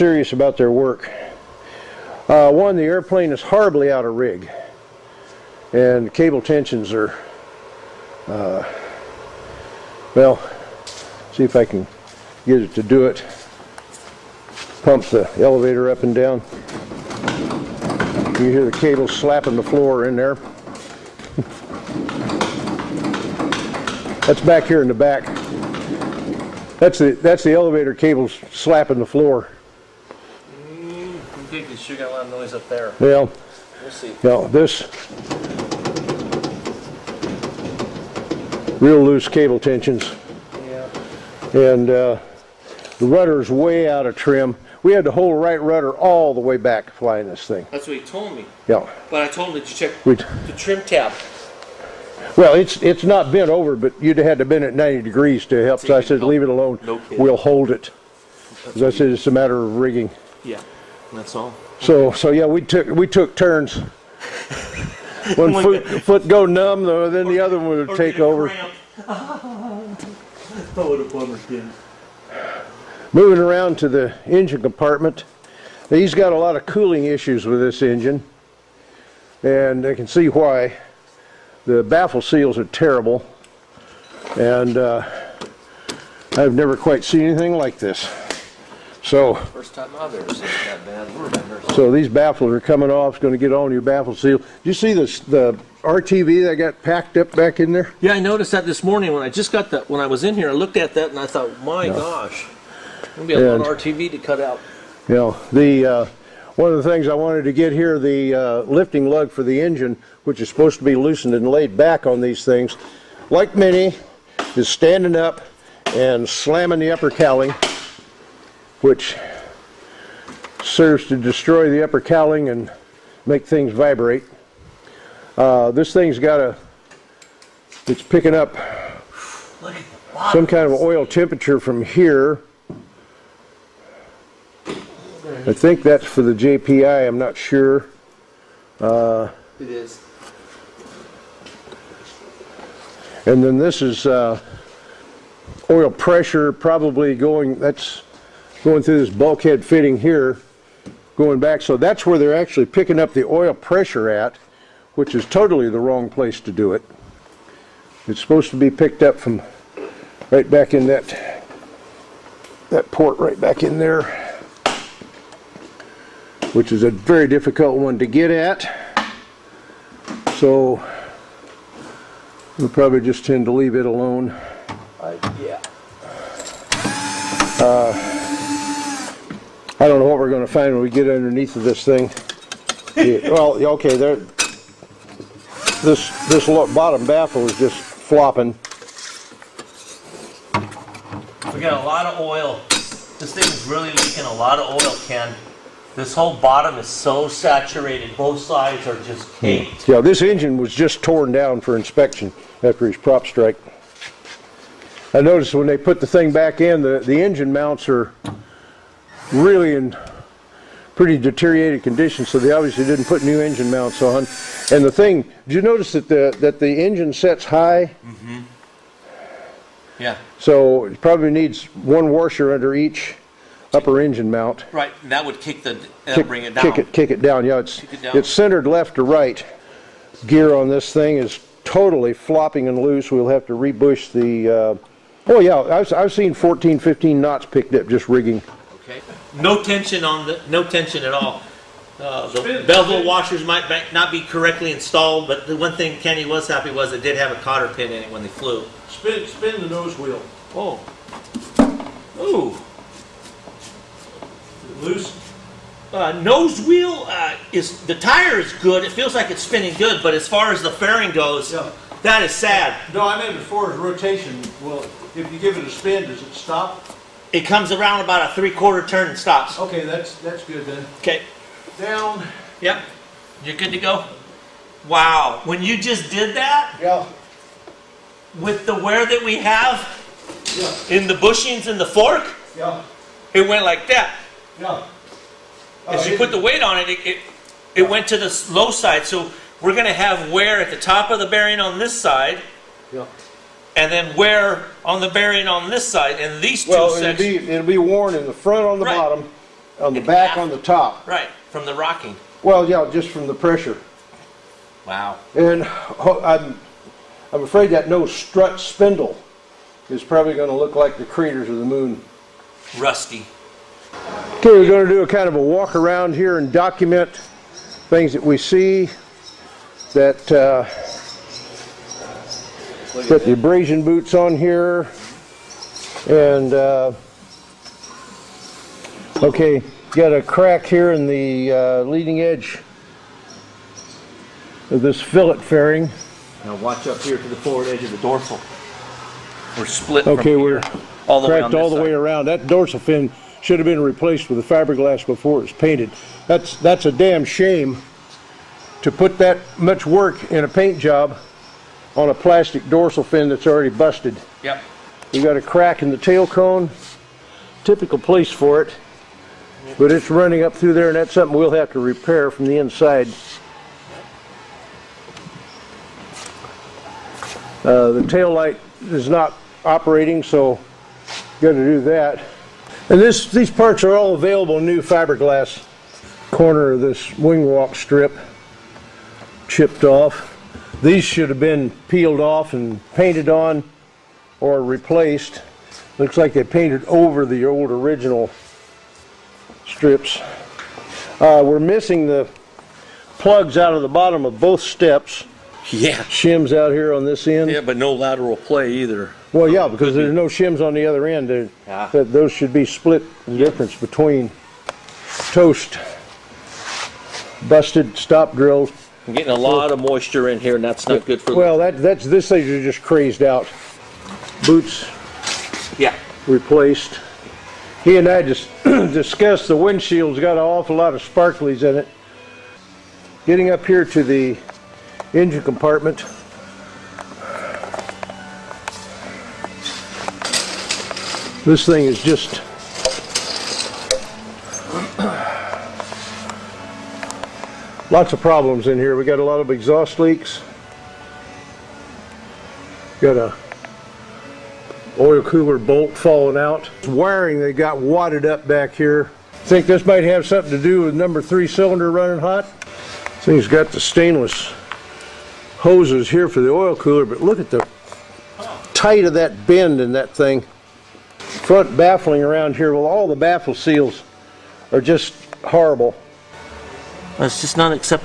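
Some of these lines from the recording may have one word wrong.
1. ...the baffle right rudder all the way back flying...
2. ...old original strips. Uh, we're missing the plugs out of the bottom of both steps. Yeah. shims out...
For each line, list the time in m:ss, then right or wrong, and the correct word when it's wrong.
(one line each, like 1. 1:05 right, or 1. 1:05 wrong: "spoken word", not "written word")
1. 0:45 wrong: "whole", not "baffle"
2. 6:27 right.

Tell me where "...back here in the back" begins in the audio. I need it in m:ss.
0:24.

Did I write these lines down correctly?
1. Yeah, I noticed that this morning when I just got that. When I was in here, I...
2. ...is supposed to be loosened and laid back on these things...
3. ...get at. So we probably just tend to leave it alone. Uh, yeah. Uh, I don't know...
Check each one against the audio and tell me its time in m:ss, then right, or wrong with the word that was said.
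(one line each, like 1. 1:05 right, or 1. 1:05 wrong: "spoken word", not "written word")
1. 1:38 right
2. 1:50 right
3. 2:48 right.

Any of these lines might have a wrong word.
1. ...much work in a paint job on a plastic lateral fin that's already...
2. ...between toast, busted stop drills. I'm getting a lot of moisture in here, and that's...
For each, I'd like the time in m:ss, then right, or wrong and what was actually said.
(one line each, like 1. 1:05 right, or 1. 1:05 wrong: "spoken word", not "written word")
1. 5:49 wrong: "dorsal", not "lateral"
2. 6:43 right.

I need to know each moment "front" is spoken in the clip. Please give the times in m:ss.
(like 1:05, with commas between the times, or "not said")
4:58, 7:41.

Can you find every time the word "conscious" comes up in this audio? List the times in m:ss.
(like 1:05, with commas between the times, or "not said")
not said.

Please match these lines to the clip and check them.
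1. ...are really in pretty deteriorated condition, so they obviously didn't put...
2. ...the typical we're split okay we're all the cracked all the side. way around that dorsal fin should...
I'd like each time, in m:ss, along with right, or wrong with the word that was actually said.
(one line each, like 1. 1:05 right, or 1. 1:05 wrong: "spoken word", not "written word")
1. 3:27 right
2. 5:37 wrong: "dorsal", not "typical".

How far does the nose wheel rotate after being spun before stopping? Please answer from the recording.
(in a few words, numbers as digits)
Three-quarter turn.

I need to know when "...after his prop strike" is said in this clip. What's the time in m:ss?
3:22.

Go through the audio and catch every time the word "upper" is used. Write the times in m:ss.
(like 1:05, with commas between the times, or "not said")
1:56, 2:01, 3:43.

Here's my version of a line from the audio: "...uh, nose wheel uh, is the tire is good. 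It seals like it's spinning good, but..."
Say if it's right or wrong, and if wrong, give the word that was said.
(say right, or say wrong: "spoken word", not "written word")
wrong: "feels", not "seals".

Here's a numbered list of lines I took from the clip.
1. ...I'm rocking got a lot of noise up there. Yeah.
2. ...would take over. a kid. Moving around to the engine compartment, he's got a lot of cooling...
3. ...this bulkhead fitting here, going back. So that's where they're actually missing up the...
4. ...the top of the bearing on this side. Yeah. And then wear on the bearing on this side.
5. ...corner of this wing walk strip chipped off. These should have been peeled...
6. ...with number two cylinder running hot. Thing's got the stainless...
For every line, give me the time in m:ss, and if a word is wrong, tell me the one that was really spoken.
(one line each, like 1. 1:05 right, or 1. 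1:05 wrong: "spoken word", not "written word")
1. 0:31 wrong: "thinking", not "rocking"
2. 1:07 right
3. 2:29 wrong: "picking", not "missing"
4. 4:50 right
5. 6:16 right
6. 7:30 wrong: "three", not "two".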